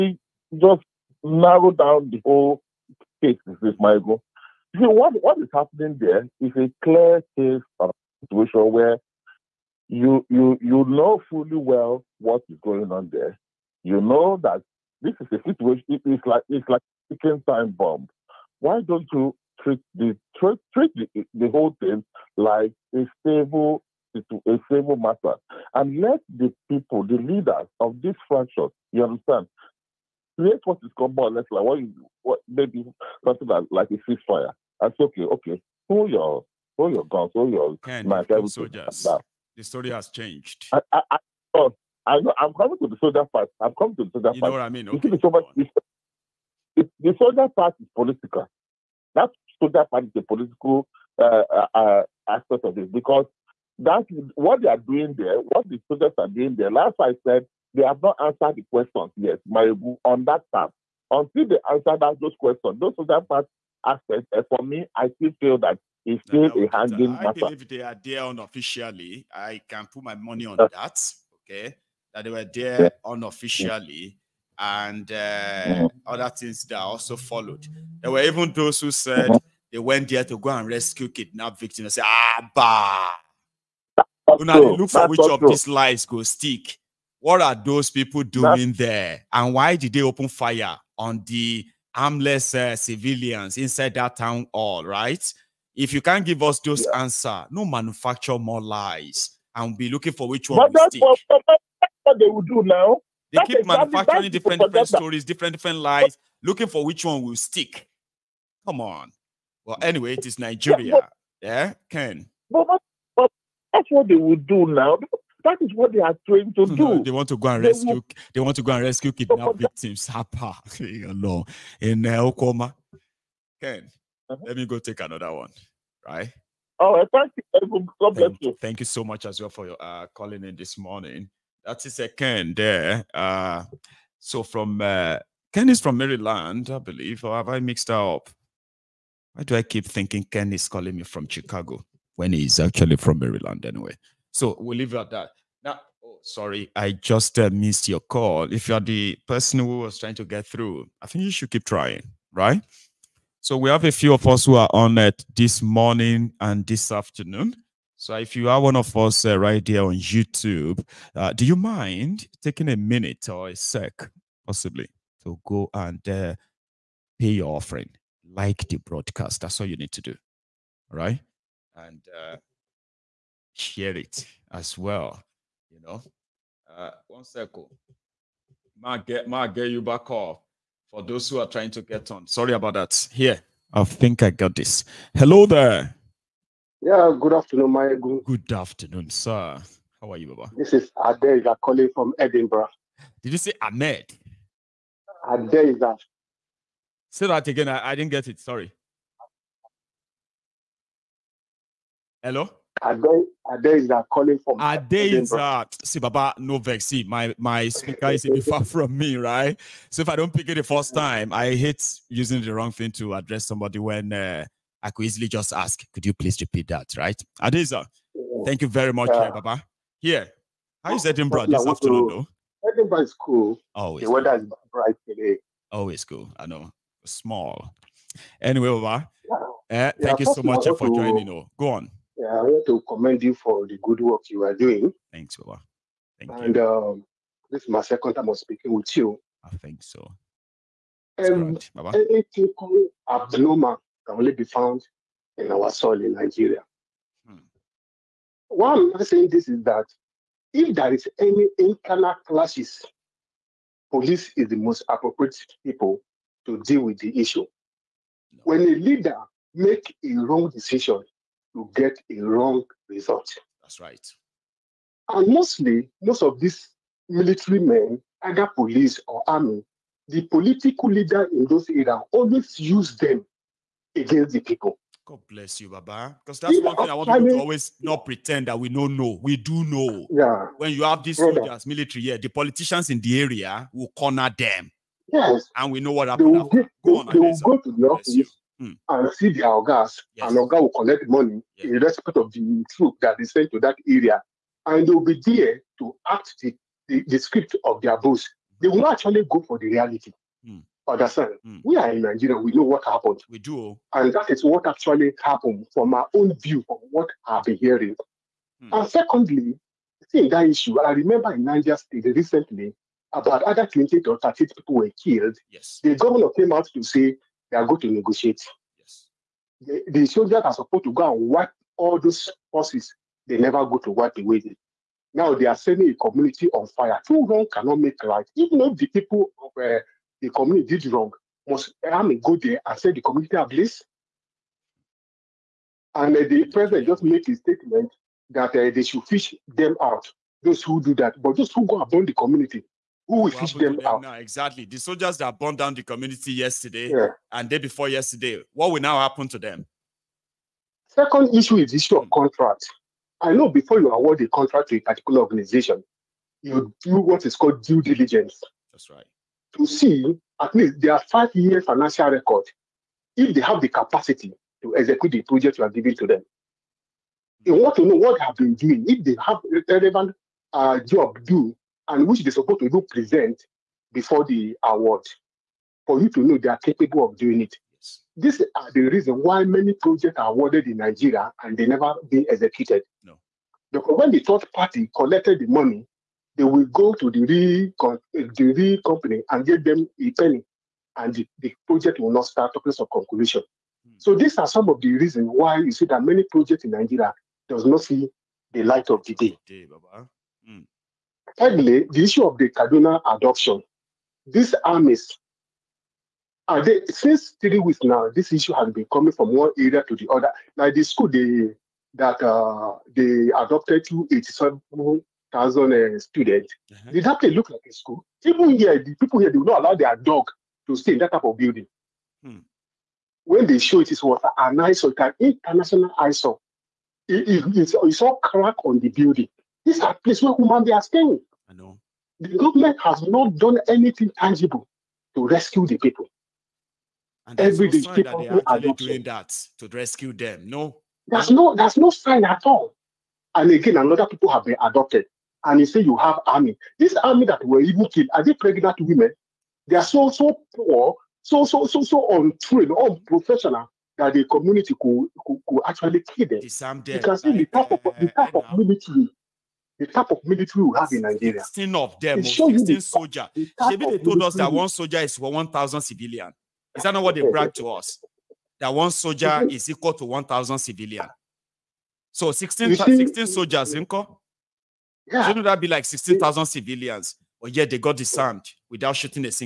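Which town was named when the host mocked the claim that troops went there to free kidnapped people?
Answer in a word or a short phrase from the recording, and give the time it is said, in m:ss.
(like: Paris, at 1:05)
Okuama, at 2:02.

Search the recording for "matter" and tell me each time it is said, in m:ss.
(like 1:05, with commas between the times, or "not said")
0:24, 1:07.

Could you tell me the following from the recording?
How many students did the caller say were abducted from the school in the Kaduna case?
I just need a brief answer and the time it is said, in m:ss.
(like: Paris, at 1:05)
87,000, at 6:54.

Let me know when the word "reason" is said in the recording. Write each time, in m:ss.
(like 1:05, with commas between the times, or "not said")
6:18, 6:34.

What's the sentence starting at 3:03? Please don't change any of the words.
Here, I think I got this.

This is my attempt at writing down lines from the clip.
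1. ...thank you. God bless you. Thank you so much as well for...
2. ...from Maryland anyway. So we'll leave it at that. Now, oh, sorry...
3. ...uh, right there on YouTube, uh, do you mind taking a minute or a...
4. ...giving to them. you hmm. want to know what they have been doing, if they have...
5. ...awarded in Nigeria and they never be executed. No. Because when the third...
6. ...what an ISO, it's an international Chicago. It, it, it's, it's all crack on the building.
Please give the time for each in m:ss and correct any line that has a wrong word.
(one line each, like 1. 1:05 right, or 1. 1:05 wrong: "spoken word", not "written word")
1. 2:07 right
2. 2:22 right
3. 2:39 right
4. 6:05 right
5. 6:20 right
6. 7:04 wrong: "ISO", not "Chicago".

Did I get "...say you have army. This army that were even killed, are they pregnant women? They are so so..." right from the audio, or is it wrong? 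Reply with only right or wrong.
right.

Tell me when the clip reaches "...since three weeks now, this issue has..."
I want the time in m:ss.
6:46.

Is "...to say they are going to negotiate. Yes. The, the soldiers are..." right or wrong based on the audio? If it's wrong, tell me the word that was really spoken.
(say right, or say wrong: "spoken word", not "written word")
right.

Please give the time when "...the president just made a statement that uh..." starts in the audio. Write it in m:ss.
5:36.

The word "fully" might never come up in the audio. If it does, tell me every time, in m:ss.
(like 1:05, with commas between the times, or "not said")
0:11.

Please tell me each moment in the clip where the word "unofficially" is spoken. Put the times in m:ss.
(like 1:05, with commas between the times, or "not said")
1:08, 1:13.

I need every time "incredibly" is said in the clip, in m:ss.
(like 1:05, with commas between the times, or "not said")
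not said.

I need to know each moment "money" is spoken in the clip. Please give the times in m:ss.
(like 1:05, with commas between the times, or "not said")
1:10, 4:51, 6:25.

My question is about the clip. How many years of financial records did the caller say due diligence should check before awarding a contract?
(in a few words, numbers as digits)
5.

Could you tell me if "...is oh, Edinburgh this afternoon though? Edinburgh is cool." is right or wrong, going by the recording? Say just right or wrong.
right.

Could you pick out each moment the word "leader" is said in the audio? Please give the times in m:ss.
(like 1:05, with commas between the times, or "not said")
0:27, 4:18, 4:30.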